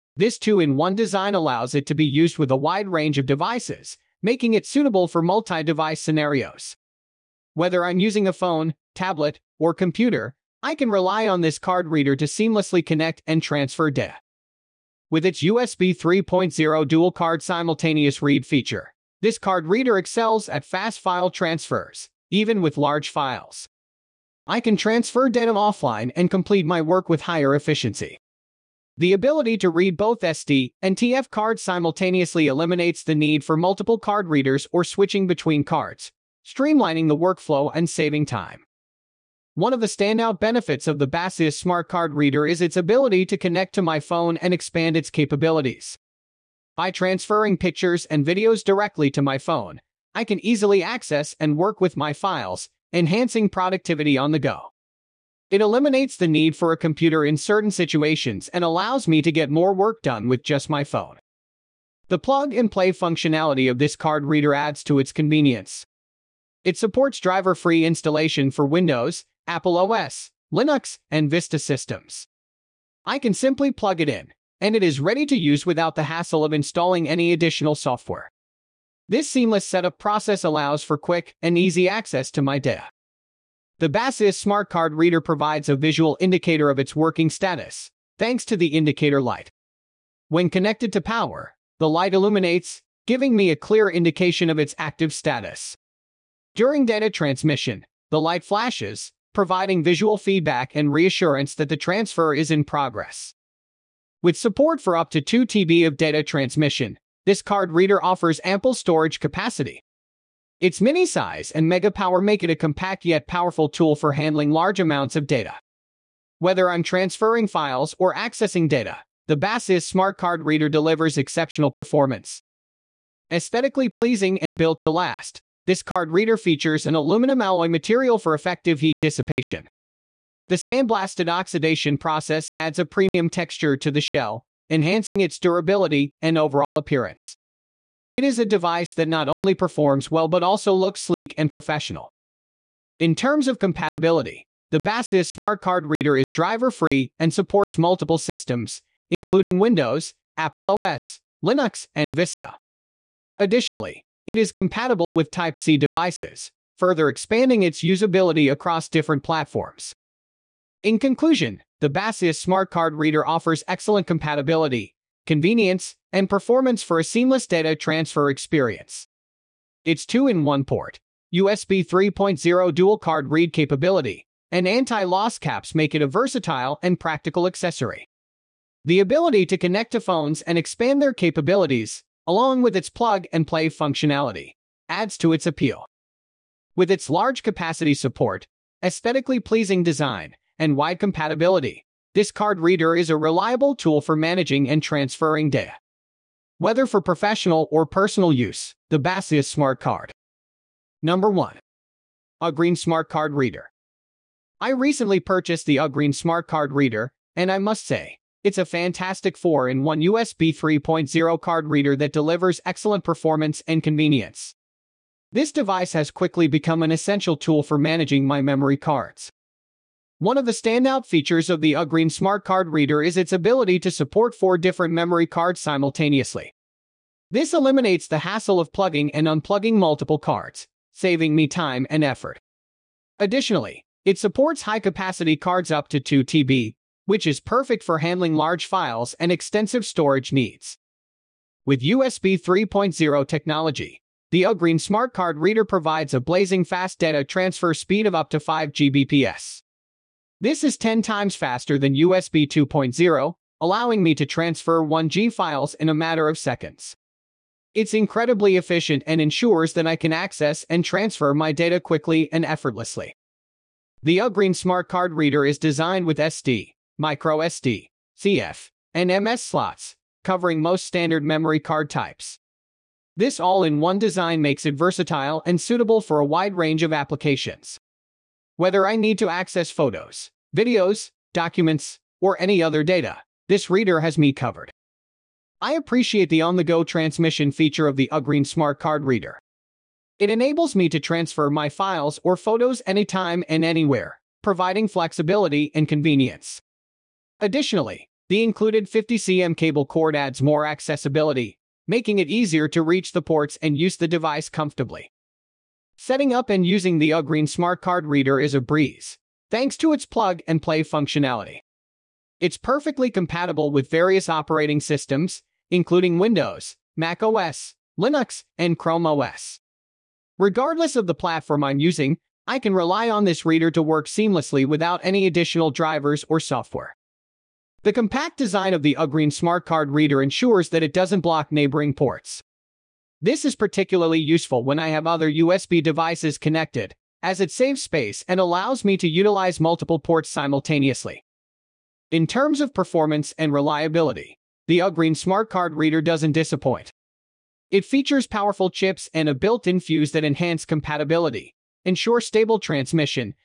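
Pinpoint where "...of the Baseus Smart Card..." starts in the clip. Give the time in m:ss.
0:40.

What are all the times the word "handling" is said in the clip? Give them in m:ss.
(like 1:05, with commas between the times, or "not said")
1:54, 3:57.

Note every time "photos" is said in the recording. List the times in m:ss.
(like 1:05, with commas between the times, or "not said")
4:39, 4:52.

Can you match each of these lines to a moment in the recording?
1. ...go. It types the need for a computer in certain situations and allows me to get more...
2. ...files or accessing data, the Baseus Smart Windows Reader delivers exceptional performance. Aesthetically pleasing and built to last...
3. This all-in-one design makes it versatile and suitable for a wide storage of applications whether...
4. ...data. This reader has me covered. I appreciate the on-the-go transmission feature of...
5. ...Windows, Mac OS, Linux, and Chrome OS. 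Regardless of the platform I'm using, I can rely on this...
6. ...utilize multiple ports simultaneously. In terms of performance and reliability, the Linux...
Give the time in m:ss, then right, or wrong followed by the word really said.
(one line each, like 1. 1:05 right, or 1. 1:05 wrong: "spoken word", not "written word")
1. 0:54 wrong: "eliminates", not "types"
2. 1:57 wrong: "Card", not "Windows"
3. 4:33 wrong: "range", not "storage"
4. 4:42 right
5. 5:16 right
6. 5:39 wrong: "Ugreen", not "Linux".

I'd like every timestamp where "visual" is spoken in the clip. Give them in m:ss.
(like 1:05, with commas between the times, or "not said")
1:25, 1:39.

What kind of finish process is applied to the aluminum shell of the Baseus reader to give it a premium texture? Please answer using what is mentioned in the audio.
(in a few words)
Sandblasted oxidation.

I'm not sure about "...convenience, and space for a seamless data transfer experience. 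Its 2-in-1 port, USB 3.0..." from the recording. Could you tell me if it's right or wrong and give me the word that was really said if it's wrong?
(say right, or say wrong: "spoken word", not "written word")
wrong: "performance", not "space".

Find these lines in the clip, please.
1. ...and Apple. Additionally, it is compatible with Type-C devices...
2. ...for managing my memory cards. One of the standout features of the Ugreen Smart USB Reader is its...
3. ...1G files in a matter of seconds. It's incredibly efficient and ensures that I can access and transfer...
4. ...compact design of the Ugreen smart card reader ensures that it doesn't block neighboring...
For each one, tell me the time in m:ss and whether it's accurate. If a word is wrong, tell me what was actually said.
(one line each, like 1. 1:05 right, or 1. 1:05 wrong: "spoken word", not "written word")
1. 2:31 wrong: "Vista", not "Apple"
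2. 3:37 wrong: "Card", not "USB"
3. 4:14 right
4. 5:27 right.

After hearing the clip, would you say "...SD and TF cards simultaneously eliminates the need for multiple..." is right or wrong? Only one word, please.
right.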